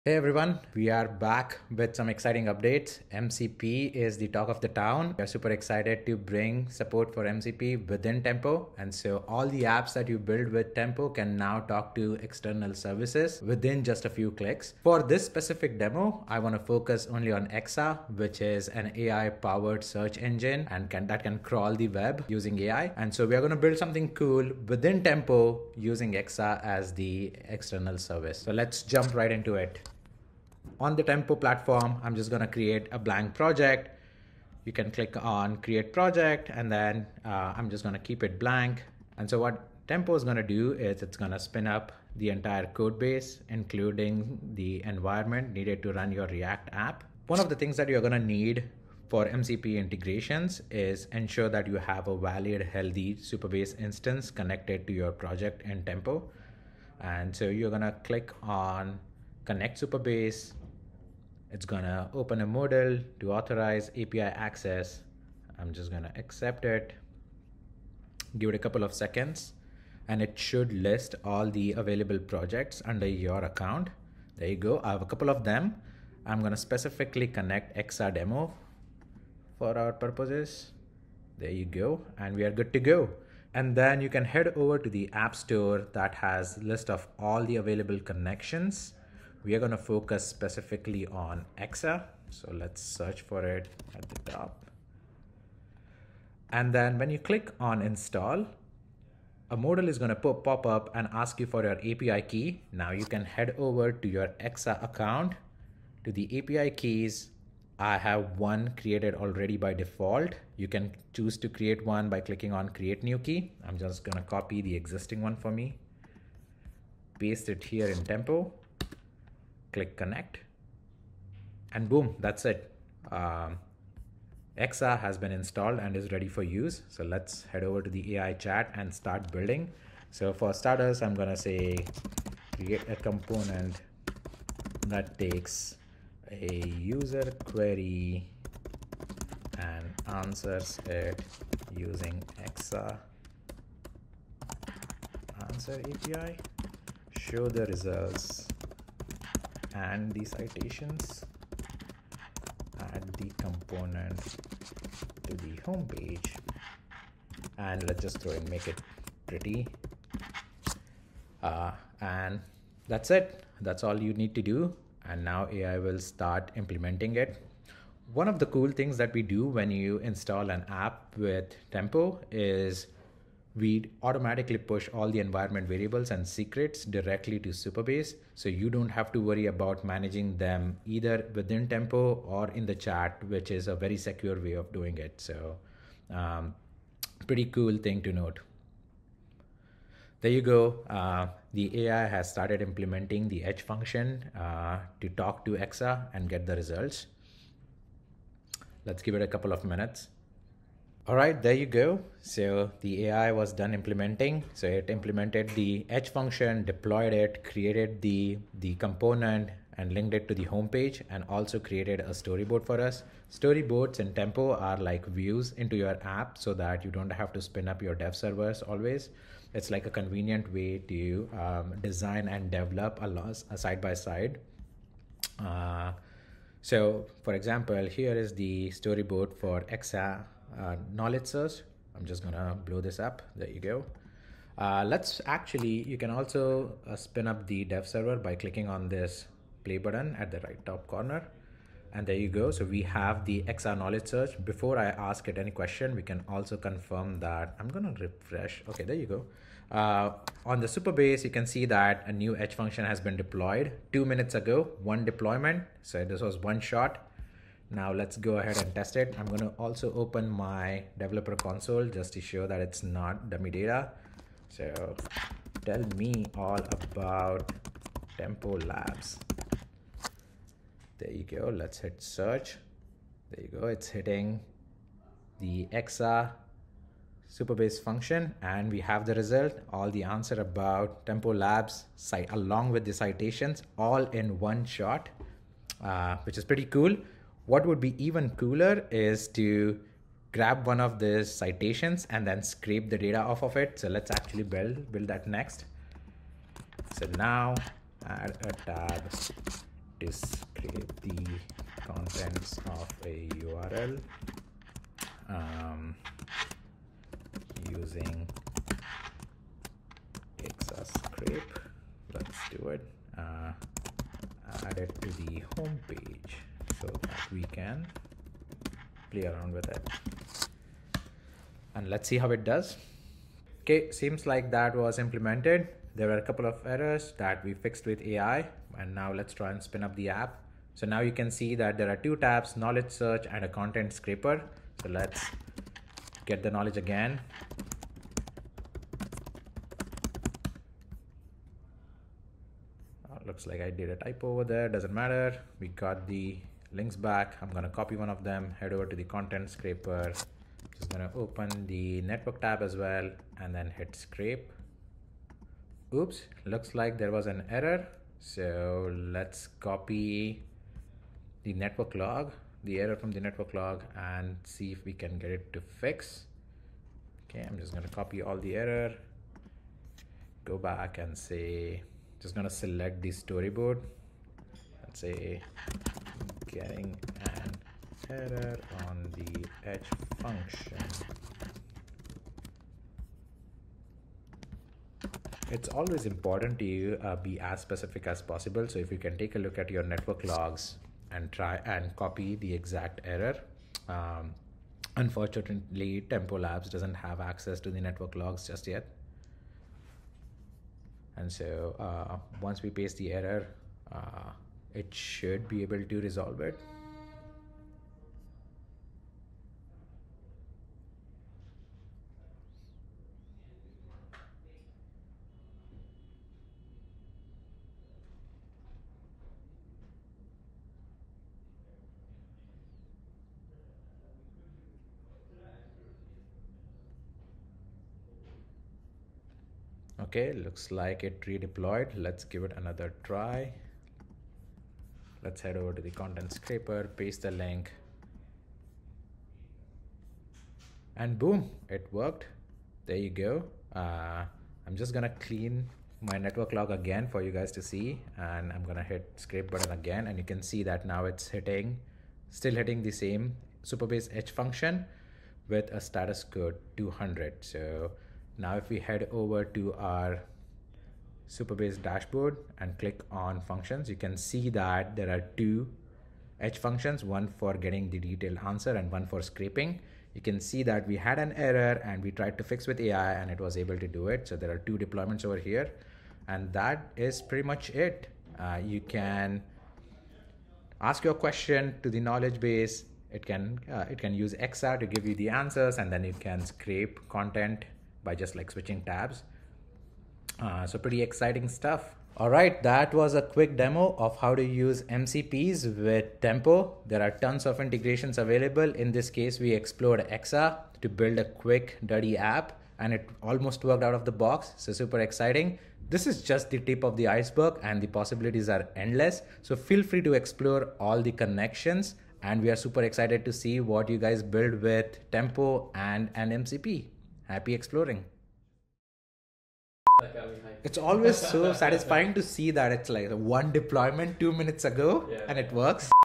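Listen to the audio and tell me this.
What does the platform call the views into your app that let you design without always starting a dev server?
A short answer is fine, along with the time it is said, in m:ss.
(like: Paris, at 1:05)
Storyboards, at 3:33.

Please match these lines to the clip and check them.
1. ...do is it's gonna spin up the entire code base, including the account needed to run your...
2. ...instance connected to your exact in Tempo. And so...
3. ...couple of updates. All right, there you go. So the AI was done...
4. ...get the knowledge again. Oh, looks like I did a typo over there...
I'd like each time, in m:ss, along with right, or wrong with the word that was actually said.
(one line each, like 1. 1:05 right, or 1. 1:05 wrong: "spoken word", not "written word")
1. 0:40 wrong: "environment", not "account"
2. 0:53 wrong: "project", not "exact"
3. 3:19 wrong: "minutes", not "updates"
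4. 5:36 right.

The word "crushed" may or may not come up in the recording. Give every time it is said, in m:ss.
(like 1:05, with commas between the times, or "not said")
not said.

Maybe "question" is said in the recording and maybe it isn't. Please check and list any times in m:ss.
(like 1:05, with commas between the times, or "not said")
4:05, 8:01.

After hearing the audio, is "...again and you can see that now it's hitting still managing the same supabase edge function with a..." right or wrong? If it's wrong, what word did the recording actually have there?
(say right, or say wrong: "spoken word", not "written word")
wrong: "hitting", not "managing".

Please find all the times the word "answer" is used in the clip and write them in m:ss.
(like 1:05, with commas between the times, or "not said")
2:20, 2:25, 4:40, 7:48, 8:05.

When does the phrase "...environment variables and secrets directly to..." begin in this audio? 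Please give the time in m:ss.
2:55.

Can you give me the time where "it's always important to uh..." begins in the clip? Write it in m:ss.
6:25.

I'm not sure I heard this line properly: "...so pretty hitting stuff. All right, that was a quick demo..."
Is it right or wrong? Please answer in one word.
wrong.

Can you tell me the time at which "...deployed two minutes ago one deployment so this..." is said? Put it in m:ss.
4:13.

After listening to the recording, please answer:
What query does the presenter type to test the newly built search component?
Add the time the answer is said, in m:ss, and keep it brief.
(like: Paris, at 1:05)
tell me all about tempo labs, at 4:25.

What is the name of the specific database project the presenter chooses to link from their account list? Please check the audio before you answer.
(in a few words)
Exa demo.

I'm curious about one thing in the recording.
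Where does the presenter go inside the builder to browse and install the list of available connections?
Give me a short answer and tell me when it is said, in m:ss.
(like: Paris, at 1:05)
app store, at 1:25.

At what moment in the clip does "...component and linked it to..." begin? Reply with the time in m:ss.
3:28.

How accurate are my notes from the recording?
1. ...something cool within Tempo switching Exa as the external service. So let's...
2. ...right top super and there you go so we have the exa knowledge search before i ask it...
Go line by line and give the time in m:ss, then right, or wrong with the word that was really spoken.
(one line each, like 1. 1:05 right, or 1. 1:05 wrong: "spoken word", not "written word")
1. 0:23 wrong: "using", not "switching"
2. 4:00 wrong: "corner", not "super".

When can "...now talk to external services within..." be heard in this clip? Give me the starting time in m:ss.
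0:11.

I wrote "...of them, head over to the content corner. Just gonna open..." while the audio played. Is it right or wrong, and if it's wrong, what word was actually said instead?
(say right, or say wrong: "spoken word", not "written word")
wrong: "scraper", not "corner".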